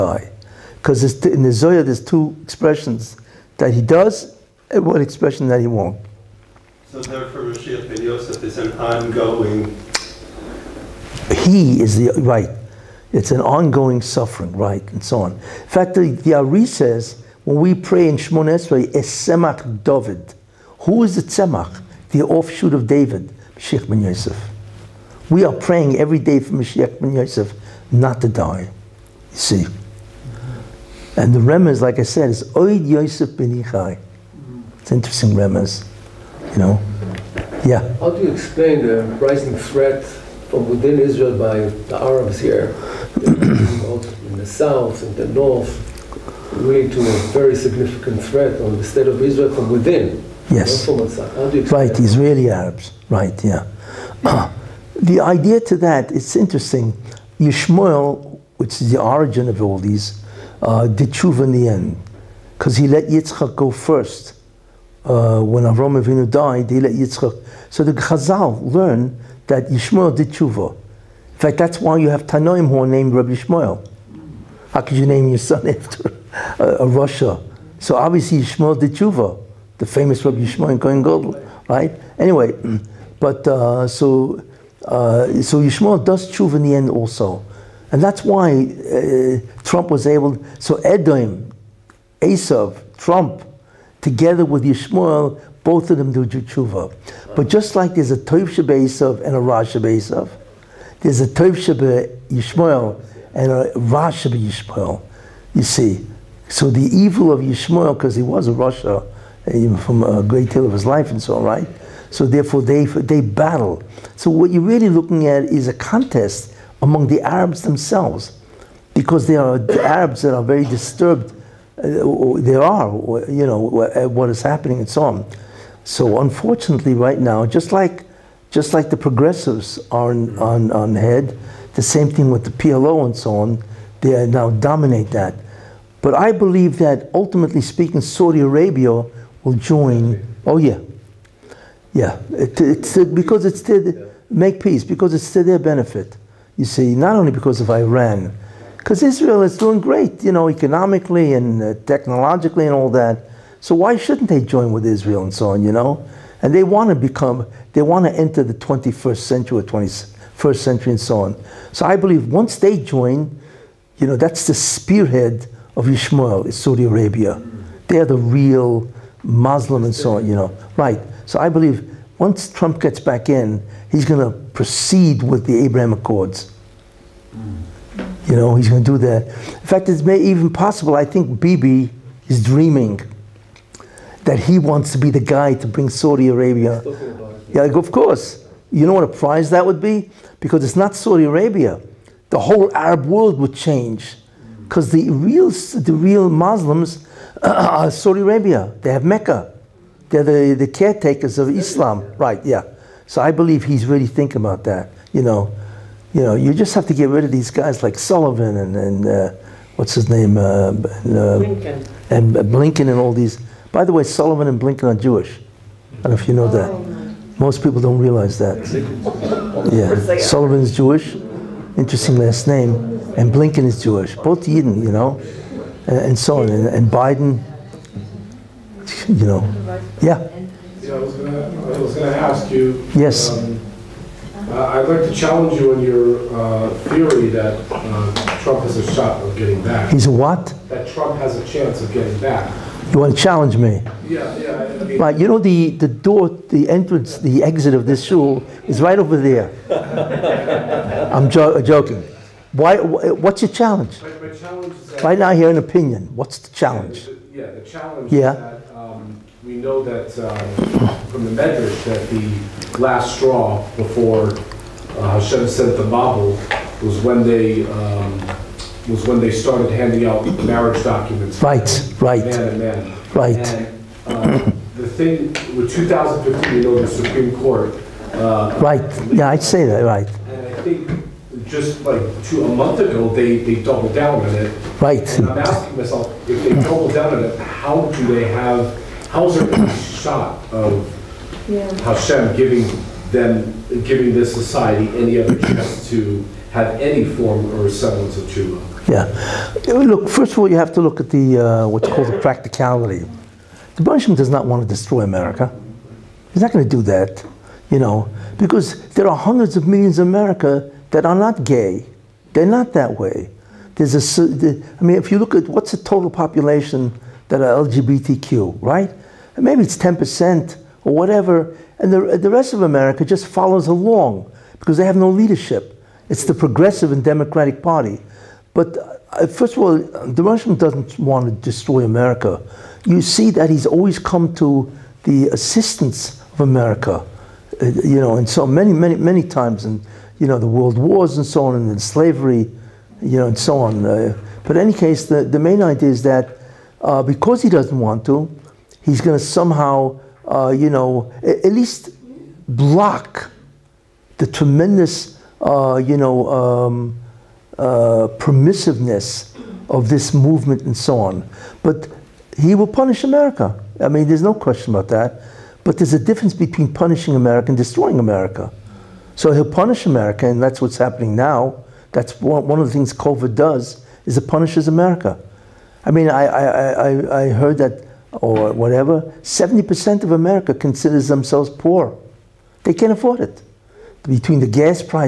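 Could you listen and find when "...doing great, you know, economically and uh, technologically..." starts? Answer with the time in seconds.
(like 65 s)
149 s.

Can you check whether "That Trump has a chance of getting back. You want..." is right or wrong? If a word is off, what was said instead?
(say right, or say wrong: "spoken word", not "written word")
right.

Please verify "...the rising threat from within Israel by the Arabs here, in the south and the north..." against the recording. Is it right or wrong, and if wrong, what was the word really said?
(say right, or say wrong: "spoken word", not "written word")
right.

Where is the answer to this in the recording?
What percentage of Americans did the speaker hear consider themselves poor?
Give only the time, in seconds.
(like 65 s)
379 s.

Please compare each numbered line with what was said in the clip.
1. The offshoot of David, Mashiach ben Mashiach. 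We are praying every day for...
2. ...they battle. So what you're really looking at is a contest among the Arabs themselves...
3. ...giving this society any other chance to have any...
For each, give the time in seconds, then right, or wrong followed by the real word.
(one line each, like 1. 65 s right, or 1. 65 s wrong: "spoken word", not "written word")
1. 22 s wrong: "Yosef", not "Mashiach"
2. 112 s right
3. 293 s right.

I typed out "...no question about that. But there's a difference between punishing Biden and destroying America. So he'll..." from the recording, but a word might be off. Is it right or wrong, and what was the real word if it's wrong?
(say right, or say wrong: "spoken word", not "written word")
wrong: "America", not "Biden".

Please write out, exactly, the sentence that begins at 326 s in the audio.
It's the progressive and democratic party.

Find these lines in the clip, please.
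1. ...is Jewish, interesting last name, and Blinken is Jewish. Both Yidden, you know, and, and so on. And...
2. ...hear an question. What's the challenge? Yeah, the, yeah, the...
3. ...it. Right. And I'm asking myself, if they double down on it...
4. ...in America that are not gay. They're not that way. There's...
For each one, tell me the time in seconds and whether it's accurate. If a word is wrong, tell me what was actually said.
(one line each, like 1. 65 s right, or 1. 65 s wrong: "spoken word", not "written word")
1. 220 s right
2. 255 s wrong: "opinion", not "question"
3. 284 s right
4. 309 s right.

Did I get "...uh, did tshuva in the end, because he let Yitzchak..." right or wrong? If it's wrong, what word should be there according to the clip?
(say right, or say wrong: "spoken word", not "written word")
right.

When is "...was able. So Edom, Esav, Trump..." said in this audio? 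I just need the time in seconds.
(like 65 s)
89 s.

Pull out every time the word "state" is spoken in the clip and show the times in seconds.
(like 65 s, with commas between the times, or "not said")
48 s.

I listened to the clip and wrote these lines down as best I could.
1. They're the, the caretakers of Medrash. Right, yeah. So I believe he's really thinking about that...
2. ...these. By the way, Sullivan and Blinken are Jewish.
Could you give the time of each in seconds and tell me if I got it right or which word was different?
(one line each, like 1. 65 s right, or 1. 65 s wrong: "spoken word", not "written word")
1. 200 s wrong: "Islam", not "Medrash"
2. 213 s right.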